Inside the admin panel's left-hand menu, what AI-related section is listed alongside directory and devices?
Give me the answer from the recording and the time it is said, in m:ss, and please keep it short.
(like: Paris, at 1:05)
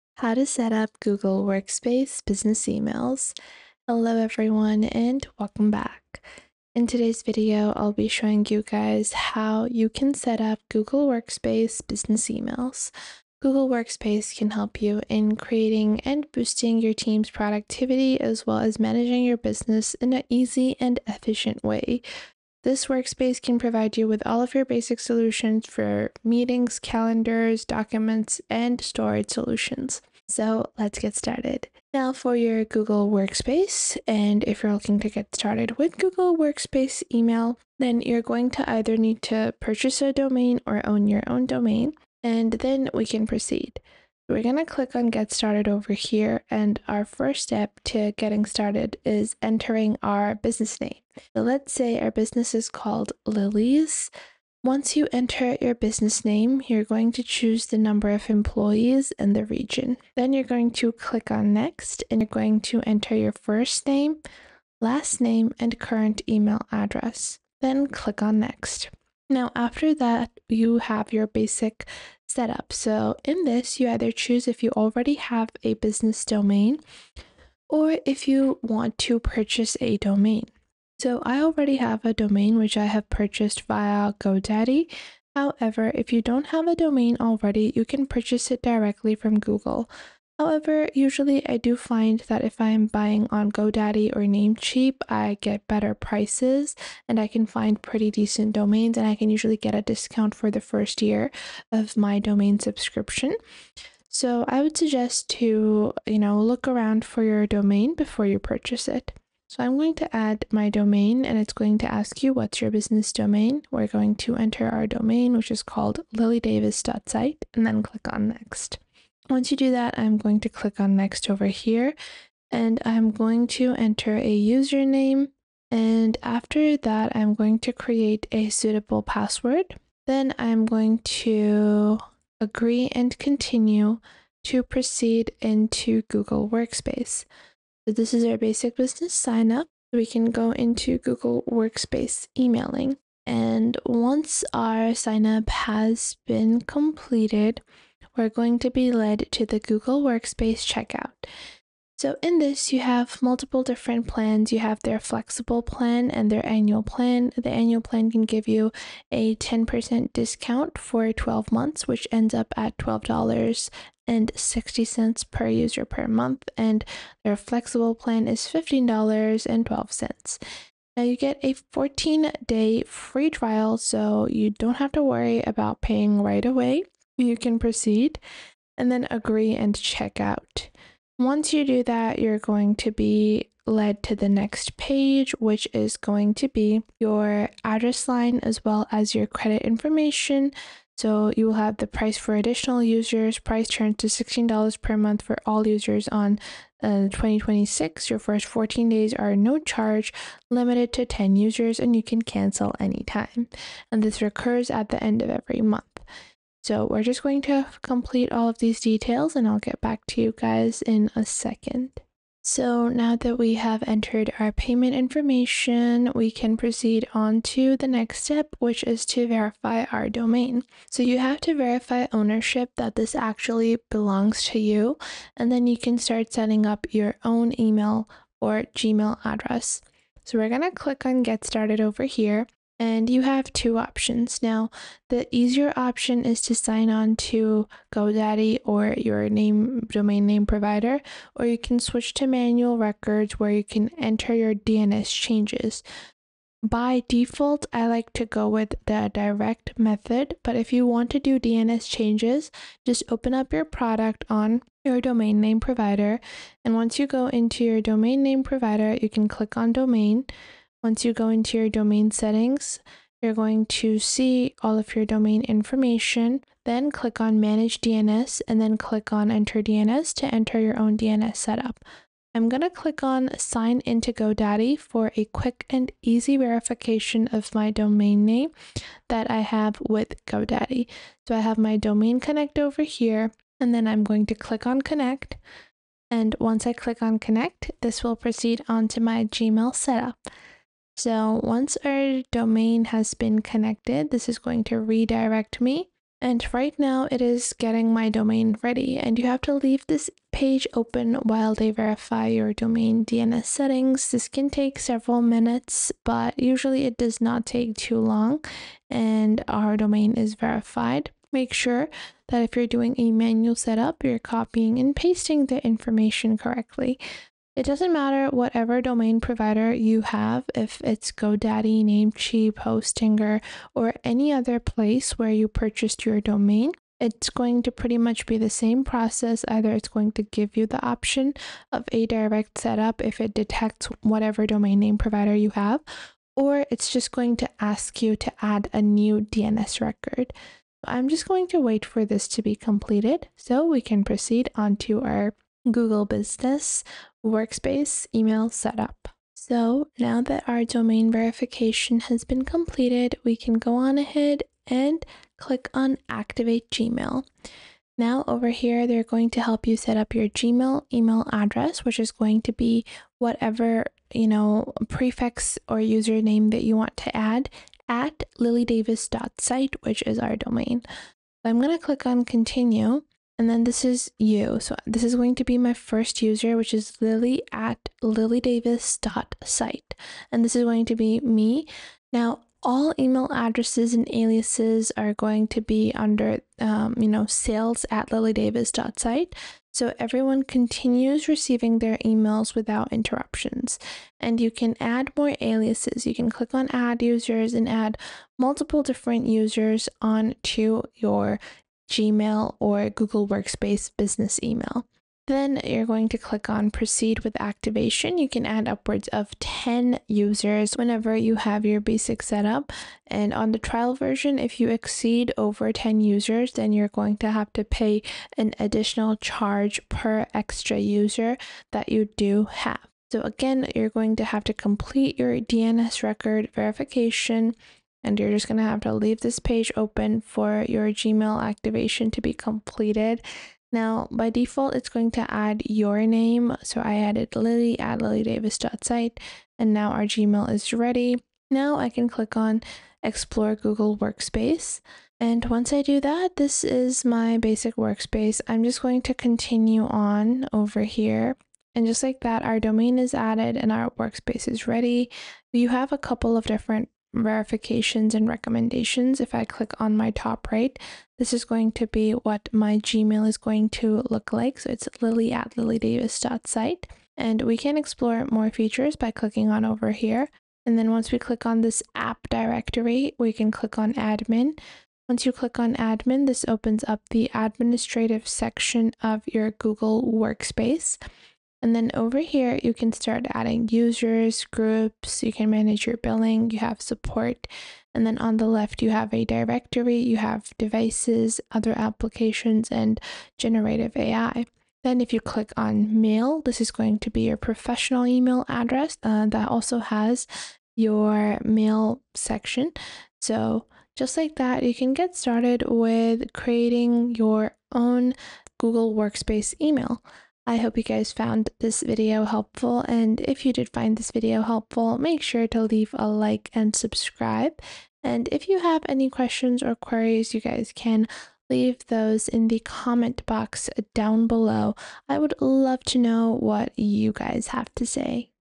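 generative AI, at 8:13.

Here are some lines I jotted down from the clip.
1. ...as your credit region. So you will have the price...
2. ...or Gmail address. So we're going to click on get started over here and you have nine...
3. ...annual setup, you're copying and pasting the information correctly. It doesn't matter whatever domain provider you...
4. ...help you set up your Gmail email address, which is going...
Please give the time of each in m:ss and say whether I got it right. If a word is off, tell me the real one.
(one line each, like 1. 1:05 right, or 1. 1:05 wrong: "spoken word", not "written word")
1. 3:08 wrong: "information", not "region"
2. 3:48 wrong: "two", not "nine"
3. 5:13 wrong: "manual", not "annual"
4. 5:59 right.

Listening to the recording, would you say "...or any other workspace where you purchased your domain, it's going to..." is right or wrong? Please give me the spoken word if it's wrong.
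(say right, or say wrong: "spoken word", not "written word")
wrong: "place", not "workspace".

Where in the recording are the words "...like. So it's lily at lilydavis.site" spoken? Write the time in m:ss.
7:44.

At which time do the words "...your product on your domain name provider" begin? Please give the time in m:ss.
4:13.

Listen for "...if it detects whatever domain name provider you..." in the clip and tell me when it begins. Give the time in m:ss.
5:33.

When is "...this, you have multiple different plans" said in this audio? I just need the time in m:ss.
2:32.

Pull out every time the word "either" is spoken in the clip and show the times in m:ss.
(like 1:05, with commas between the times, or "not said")
0:38, 1:13, 5:29.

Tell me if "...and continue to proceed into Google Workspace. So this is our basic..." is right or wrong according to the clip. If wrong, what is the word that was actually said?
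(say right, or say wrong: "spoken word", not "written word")
right.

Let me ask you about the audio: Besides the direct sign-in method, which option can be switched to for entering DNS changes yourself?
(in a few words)
manual records.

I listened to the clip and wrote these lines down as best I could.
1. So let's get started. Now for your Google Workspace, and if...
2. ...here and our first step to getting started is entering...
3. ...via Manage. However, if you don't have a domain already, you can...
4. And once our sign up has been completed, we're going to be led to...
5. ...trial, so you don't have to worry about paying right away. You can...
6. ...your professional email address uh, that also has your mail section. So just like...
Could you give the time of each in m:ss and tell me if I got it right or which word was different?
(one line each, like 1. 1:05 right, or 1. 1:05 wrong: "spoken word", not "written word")
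1. 0:30 right
2. 0:45 right
3. 1:23 wrong: "GoDaddy", not "Manage"
4. 2:23 right
5. 2:53 right
6. 8:17 right.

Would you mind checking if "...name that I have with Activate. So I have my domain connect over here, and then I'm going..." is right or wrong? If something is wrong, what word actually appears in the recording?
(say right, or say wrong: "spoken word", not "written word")
wrong: "GoDaddy", not "Activate".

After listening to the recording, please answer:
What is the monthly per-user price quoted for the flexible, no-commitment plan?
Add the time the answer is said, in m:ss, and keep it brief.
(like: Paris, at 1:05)
$15.12, at 2:48.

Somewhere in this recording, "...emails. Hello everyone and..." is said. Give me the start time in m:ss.
0:02.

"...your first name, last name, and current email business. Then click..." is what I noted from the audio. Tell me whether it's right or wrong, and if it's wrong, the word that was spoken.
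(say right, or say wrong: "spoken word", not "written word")
wrong: "address", not "business".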